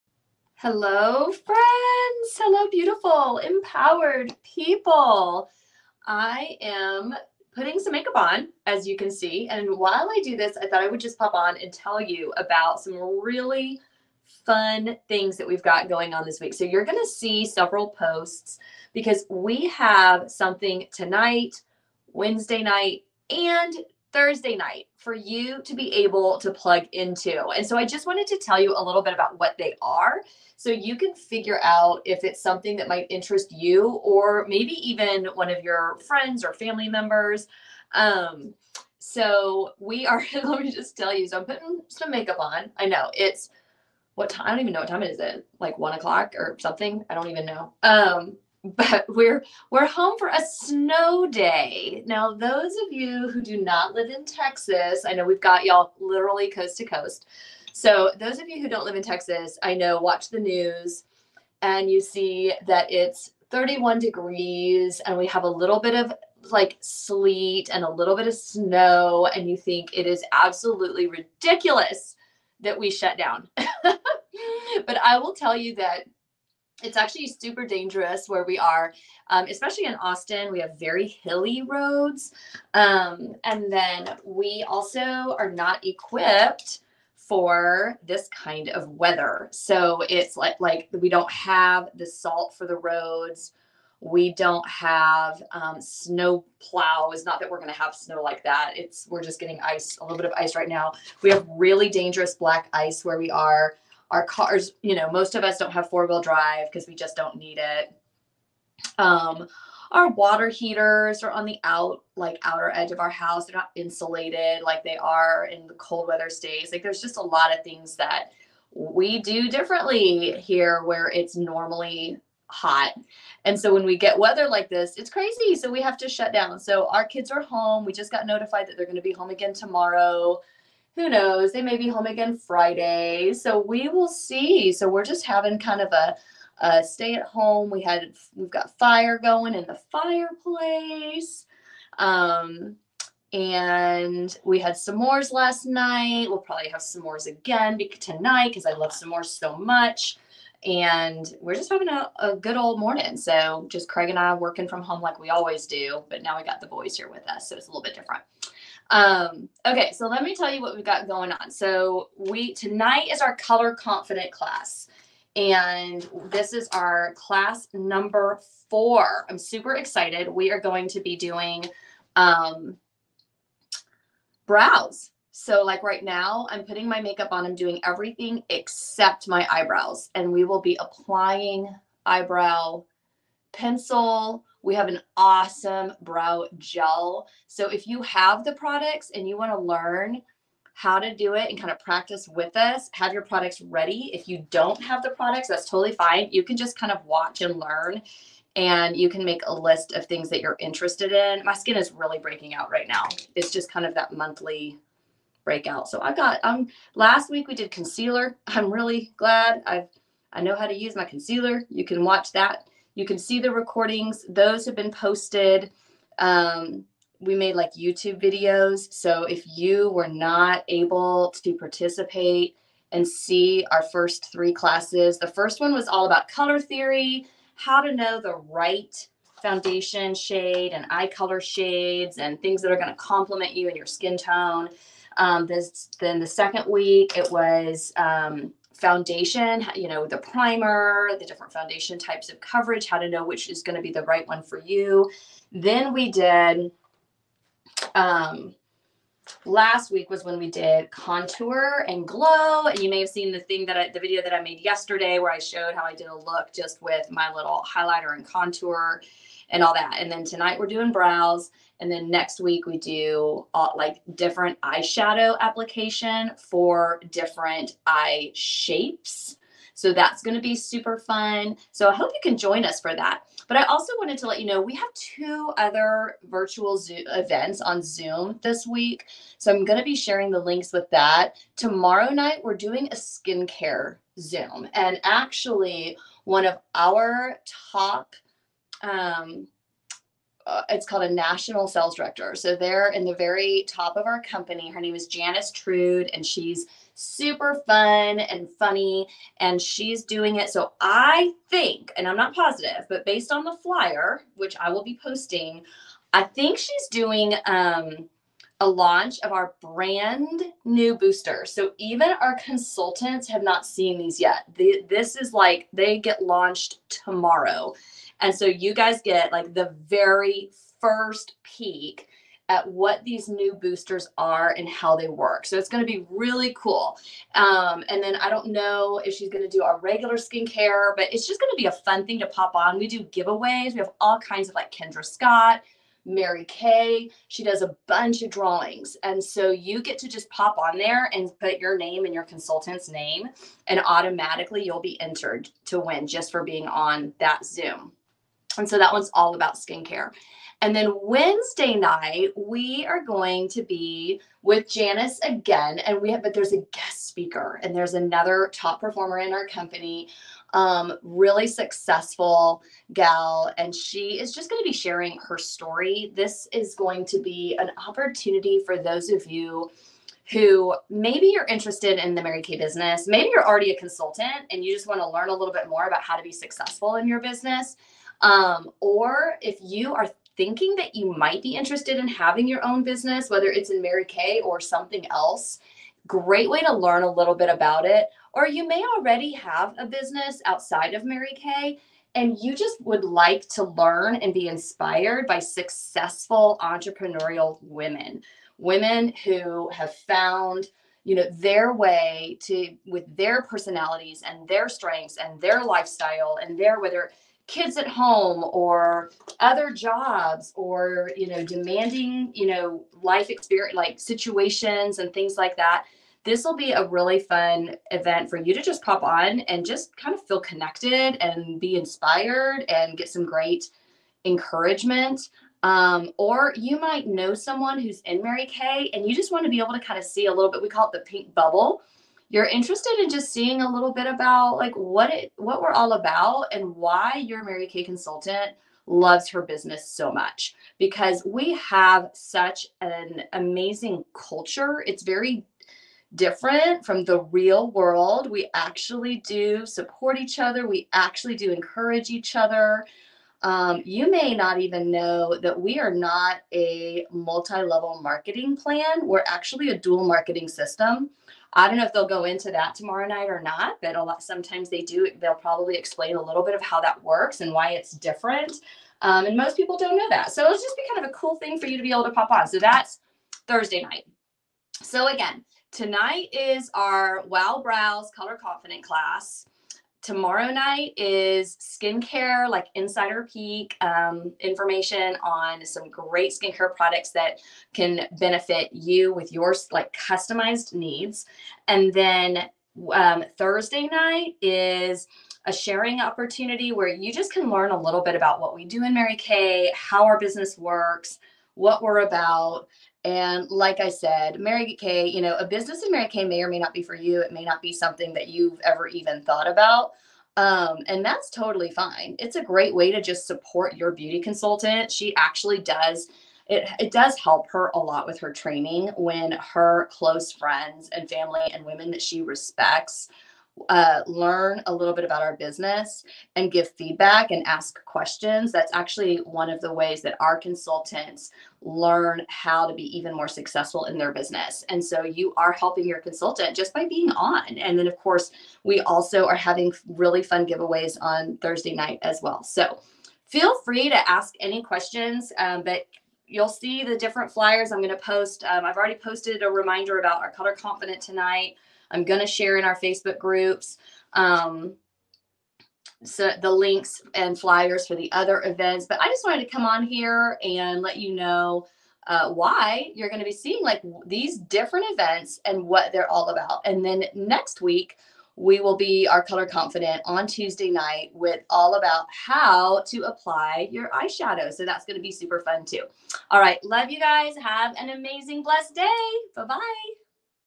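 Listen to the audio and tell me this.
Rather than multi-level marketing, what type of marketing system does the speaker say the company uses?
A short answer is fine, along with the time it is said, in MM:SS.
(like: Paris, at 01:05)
Dual marketing system, at 07:39.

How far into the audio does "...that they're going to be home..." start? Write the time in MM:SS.
02:08.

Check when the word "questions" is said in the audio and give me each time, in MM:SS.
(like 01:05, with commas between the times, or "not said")
08:47, 09:04.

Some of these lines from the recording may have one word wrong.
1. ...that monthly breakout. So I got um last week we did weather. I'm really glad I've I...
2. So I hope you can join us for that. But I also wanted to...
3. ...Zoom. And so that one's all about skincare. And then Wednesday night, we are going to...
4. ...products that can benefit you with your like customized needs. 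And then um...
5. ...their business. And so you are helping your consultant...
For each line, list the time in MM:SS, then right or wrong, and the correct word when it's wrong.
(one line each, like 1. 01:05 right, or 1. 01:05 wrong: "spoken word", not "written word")
1. 03:23 wrong: "concealer", not "weather"
2. 04:31 right
3. 05:47 right
4. 08:06 right
5. 08:53 right.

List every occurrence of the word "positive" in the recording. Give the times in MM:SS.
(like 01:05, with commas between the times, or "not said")
05:02.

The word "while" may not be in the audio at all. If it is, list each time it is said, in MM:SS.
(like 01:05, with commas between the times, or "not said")
00:09.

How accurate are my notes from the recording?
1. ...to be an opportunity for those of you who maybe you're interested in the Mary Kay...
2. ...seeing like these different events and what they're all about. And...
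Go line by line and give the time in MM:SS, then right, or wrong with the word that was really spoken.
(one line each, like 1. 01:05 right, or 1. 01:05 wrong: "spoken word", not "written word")
1. 06:07 right
2. 09:23 right.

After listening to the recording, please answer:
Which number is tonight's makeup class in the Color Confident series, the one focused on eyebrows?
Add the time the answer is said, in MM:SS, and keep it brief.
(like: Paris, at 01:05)
4, at 02:47.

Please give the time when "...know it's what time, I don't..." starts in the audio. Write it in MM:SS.
00:42.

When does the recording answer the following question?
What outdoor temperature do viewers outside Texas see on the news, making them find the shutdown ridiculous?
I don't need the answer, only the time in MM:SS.
01:03.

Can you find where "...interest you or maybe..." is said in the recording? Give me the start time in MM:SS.
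00:33.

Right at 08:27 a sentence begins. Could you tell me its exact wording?
It may not be something that you've ever even thought about.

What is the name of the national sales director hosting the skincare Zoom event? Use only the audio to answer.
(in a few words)
Janice Trude.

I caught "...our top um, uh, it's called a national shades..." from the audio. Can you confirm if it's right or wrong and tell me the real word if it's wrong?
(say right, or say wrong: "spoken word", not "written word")
wrong: "sales", not "shades".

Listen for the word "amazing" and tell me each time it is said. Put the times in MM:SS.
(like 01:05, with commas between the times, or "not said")
07:23, 09:37.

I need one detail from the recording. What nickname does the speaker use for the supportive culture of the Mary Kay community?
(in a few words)
The pink bubble.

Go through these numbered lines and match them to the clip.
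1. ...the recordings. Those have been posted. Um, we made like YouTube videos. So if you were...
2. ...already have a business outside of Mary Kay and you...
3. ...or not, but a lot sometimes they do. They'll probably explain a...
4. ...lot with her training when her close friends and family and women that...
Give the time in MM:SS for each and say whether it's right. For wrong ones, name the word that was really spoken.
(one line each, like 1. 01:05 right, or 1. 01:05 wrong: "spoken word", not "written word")
1. 03:33 right
2. 06:28 right
3. 07:43 right
4. 08:37 right.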